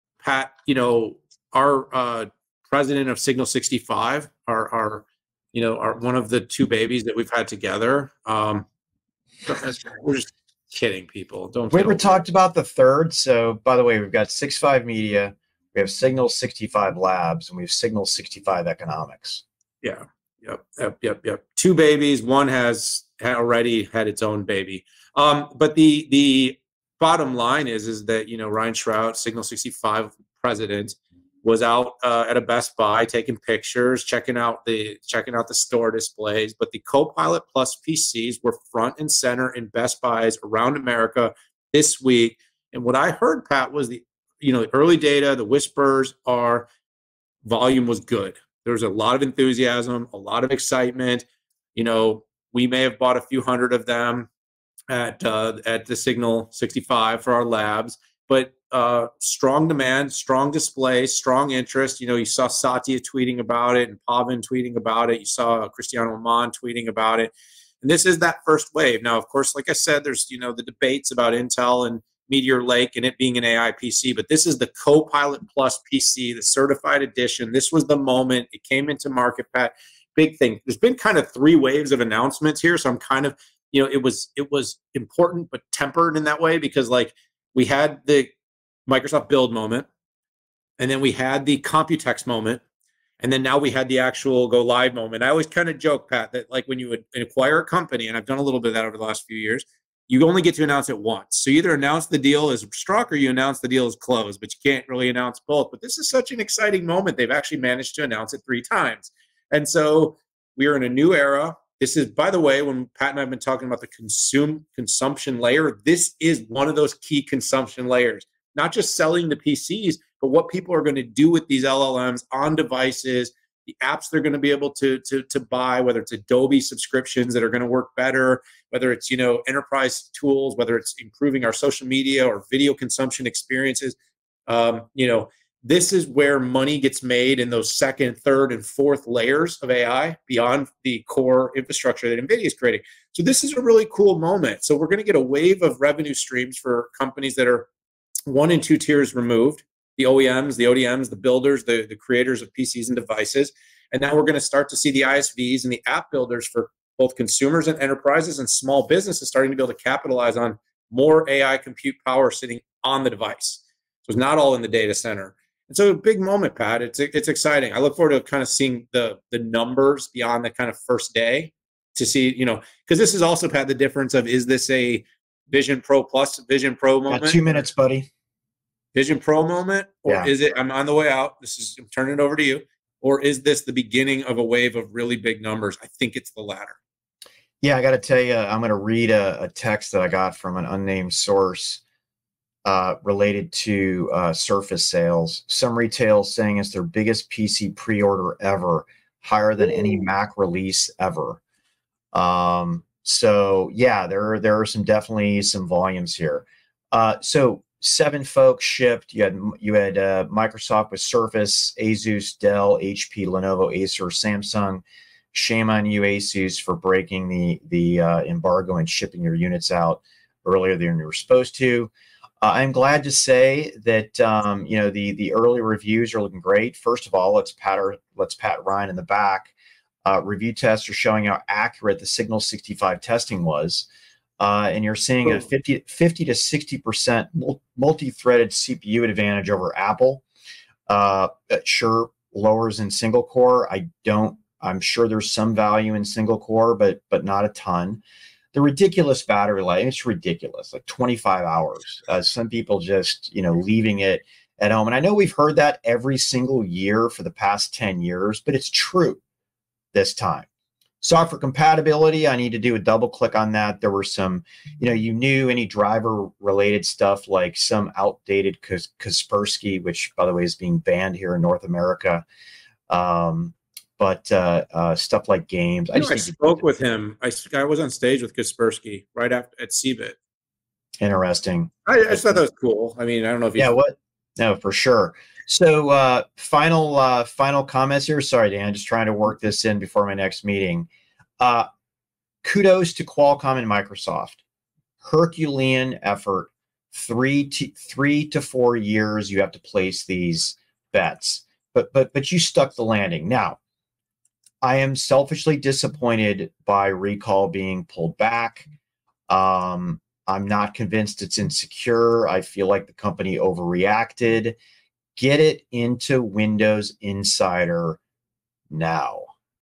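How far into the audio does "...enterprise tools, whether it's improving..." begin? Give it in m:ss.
2:09.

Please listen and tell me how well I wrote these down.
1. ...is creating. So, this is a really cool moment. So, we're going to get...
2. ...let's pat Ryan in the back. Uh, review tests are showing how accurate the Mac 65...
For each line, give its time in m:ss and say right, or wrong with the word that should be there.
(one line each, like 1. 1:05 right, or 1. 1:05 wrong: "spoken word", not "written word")
1. 2:22 right
2. 3:48 wrong: "Signal", not "Mac".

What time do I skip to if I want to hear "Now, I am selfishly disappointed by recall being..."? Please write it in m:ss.
5:03.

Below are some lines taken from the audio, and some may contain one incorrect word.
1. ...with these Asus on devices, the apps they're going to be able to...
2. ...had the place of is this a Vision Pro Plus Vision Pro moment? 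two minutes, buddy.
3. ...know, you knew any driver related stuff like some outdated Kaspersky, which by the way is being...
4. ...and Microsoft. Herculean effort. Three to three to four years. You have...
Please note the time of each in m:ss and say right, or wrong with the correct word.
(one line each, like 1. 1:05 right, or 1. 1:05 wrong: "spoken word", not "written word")
1. 2:01 wrong: "LLMs", not "Asus"
2. 2:53 wrong: "difference", not "place"
3. 4:24 right
4. 4:53 right.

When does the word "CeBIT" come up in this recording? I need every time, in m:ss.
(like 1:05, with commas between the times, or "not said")
4:39.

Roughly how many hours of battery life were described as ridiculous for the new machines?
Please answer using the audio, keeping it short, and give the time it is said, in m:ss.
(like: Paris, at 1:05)
25 hours, at 4:10.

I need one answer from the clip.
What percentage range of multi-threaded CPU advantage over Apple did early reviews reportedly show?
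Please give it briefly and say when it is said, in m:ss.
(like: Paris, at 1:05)
50 to 60 percent, at 3:56.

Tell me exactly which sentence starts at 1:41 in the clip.
So you either announce the deal is struck or you announce the deal is closed, but you can't really announce both.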